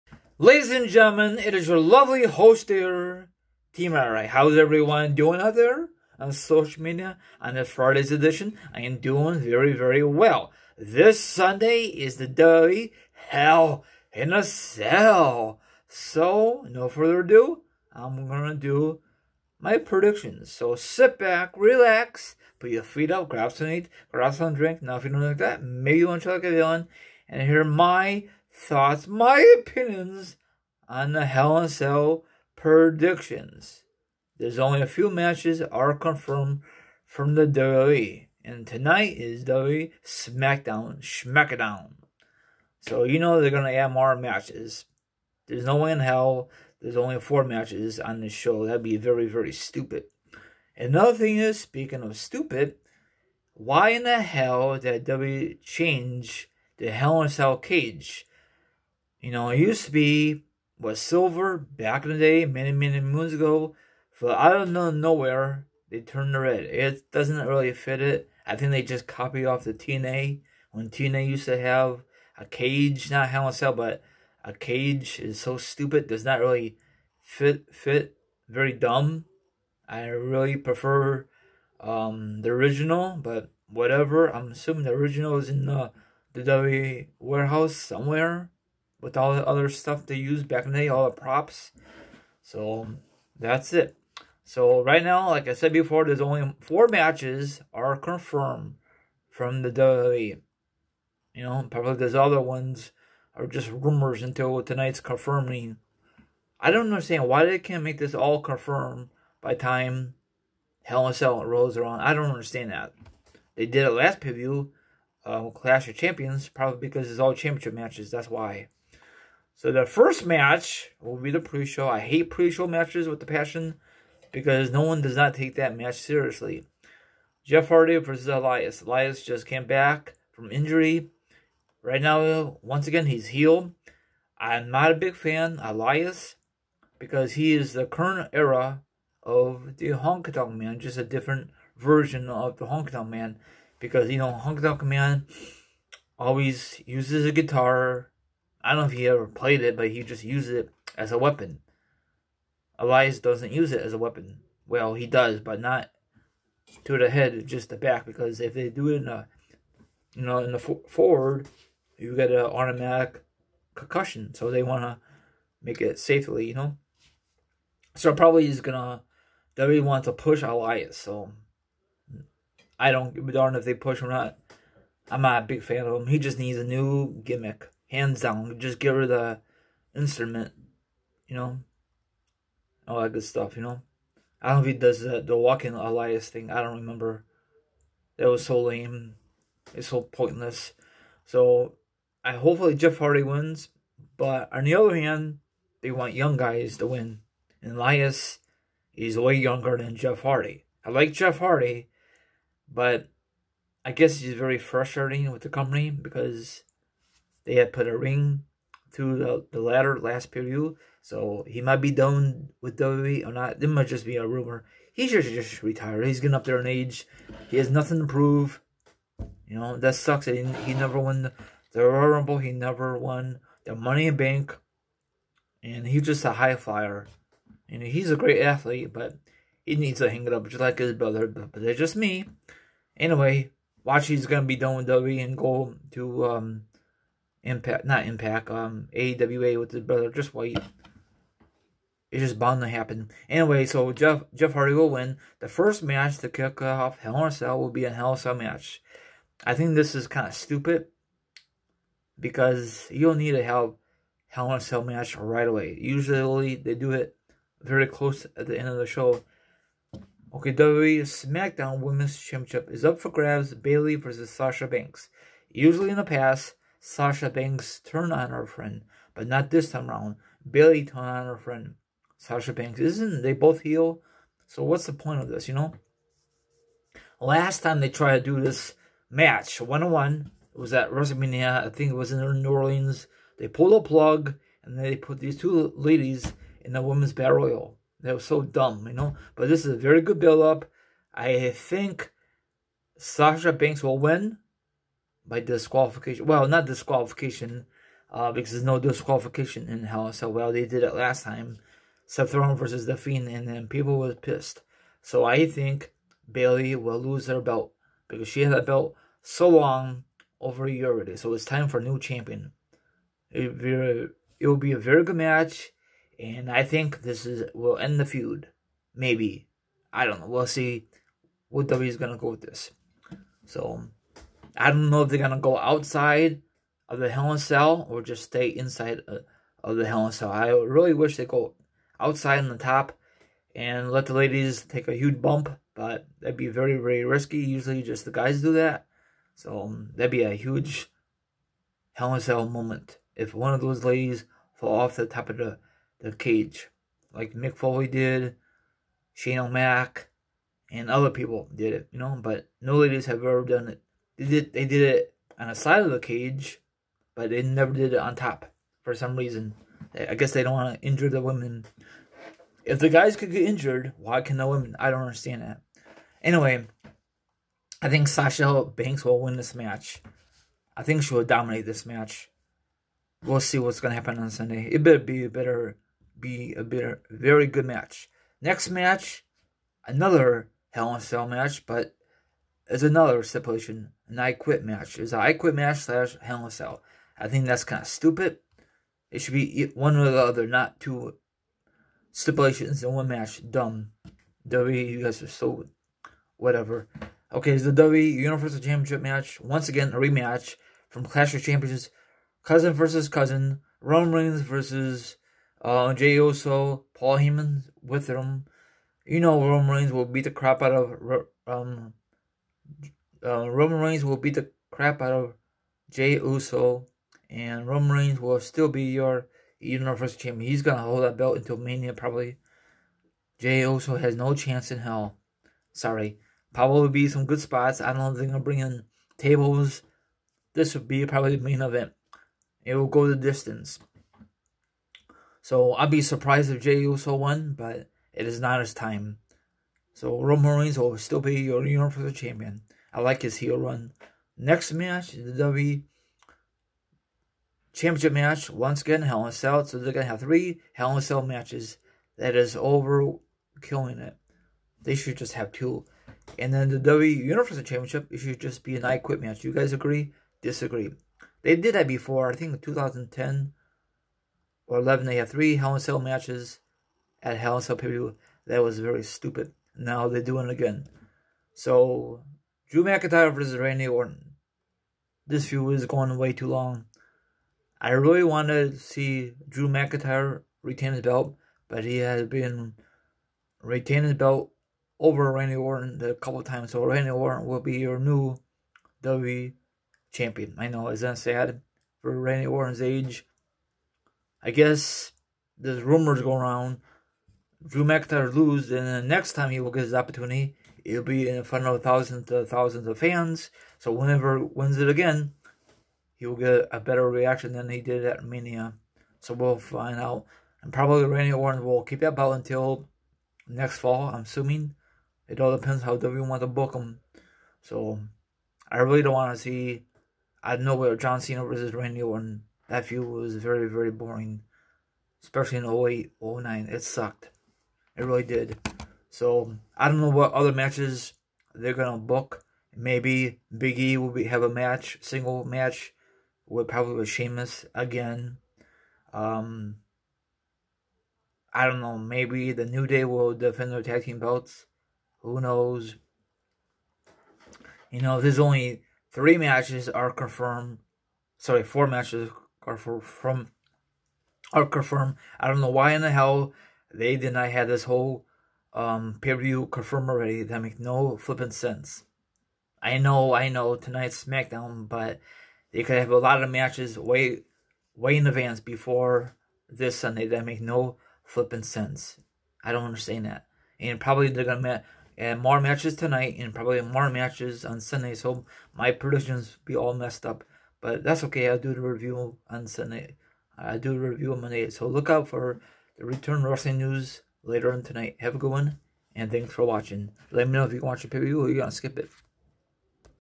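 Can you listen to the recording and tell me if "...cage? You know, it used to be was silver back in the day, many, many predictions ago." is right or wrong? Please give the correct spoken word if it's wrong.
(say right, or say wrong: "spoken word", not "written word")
wrong: "moons", not "predictions".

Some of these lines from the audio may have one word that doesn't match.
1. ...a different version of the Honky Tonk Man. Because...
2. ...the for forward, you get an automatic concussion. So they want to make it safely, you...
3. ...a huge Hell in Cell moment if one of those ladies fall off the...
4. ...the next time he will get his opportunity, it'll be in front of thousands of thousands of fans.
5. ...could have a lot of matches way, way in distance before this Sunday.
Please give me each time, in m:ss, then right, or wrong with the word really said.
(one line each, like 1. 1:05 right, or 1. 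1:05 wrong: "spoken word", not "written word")
1. 2:20 right
2. 2:40 right
3. 5:40 right
4. 8:18 right
5. 9:25 wrong: "advance", not "distance".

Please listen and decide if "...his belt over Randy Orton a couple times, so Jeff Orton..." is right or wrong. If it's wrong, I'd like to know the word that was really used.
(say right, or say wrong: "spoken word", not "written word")
wrong: "Randy", not "Jeff".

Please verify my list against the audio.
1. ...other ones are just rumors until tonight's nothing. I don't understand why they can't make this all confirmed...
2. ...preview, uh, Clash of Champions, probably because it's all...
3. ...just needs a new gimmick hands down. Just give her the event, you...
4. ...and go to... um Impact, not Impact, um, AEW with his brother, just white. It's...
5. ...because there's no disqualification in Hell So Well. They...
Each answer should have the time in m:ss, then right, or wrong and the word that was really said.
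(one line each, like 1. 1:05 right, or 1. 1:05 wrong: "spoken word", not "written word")
1. 1:42 wrong: "confirming", not "nothing"
2. 1:54 right
3. 2:56 wrong: "instrument", not "event"
4. 3:55 right
5. 4:58 right.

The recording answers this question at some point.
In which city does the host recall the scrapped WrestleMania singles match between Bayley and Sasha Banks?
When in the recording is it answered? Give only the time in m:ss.
4:42.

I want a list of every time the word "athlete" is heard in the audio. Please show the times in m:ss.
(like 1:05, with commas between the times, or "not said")
3:48.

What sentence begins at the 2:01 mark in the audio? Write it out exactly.
I hate pre-show matches with the passion because no one does not take that match seriously.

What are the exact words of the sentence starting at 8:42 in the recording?
That feud was very, very boring.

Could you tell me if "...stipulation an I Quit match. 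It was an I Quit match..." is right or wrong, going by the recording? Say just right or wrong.
right.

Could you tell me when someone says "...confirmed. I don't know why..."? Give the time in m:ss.
9:14.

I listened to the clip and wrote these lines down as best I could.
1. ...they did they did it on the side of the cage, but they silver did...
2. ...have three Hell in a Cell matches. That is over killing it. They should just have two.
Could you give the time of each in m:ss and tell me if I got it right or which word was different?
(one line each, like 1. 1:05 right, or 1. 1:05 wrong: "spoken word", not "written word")
1. 5:54 wrong: "never", not "silver"
2. 7:30 right.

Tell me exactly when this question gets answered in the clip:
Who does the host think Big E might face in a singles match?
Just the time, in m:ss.
8:57.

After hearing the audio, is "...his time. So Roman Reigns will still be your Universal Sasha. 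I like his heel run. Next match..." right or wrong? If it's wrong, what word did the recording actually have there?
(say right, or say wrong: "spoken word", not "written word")
wrong: "Champion", not "Sasha".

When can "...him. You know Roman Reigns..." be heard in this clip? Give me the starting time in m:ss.
6:48.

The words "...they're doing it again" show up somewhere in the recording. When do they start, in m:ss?
7:50.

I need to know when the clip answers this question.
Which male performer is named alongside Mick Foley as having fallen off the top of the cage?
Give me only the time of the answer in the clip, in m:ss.
5:49.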